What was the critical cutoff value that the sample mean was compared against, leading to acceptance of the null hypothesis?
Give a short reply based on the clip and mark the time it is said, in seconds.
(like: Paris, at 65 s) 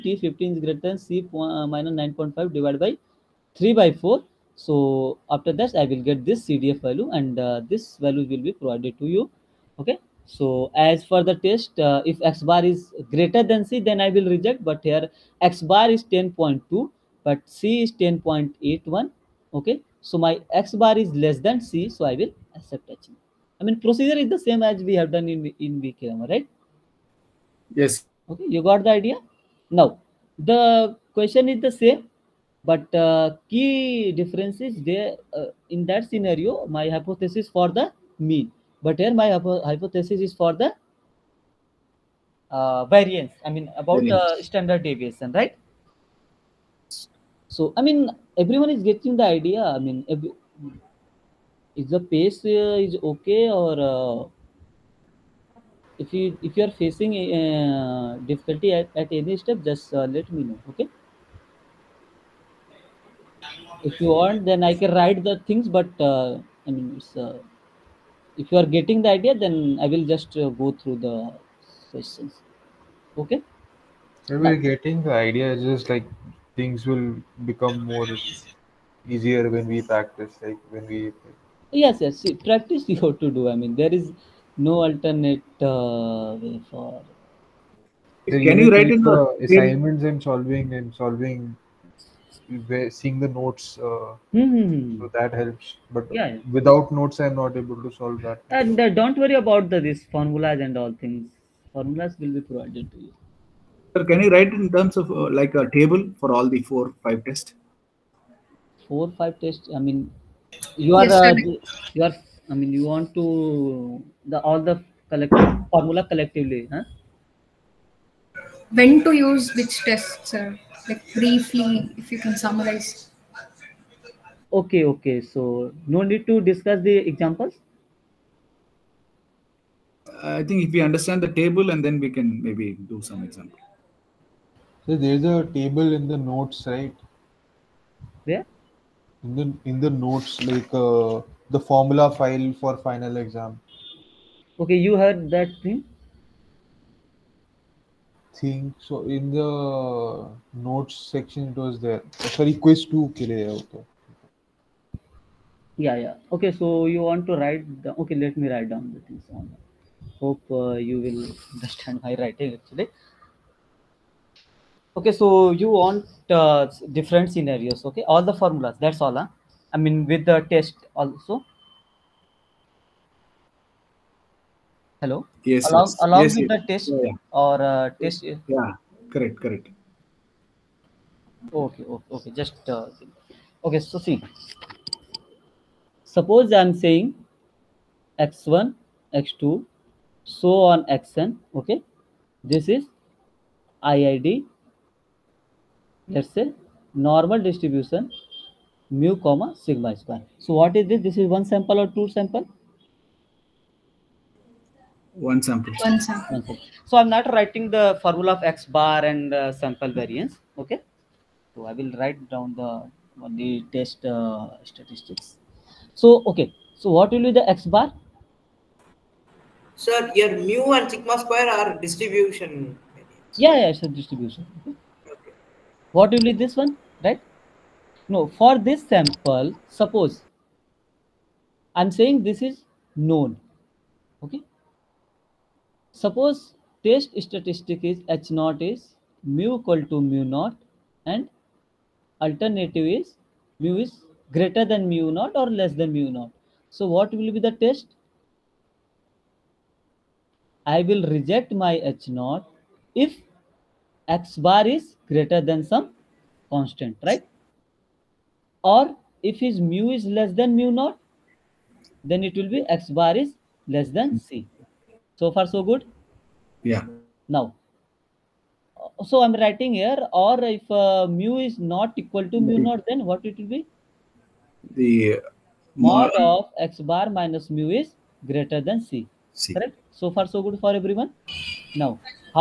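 10.81, at 18 s.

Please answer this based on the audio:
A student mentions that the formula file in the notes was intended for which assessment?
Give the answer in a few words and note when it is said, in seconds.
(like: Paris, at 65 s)
quiz 2, at 152 s.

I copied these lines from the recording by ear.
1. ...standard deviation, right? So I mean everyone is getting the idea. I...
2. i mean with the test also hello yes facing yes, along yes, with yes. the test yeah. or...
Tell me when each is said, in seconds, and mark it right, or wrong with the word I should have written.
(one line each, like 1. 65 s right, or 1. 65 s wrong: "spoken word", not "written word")
1. 44 s right
2. 169 s wrong: "along", not "facing".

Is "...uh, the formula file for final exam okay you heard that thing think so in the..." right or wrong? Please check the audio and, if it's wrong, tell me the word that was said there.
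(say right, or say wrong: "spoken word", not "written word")
right.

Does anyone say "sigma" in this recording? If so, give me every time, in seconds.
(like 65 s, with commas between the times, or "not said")
199 s, 220 s.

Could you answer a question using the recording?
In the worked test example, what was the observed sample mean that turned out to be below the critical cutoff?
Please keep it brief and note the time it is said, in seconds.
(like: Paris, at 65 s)
10.2, at 16 s.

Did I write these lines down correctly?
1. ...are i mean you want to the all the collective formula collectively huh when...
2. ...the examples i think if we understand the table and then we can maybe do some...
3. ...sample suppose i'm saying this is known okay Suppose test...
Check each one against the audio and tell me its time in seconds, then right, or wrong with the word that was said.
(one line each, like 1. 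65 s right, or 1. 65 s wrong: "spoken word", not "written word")
1. 112 s right
2. 126 s right
3. 228 s right.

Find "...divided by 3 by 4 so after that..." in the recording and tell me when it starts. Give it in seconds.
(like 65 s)
2 s.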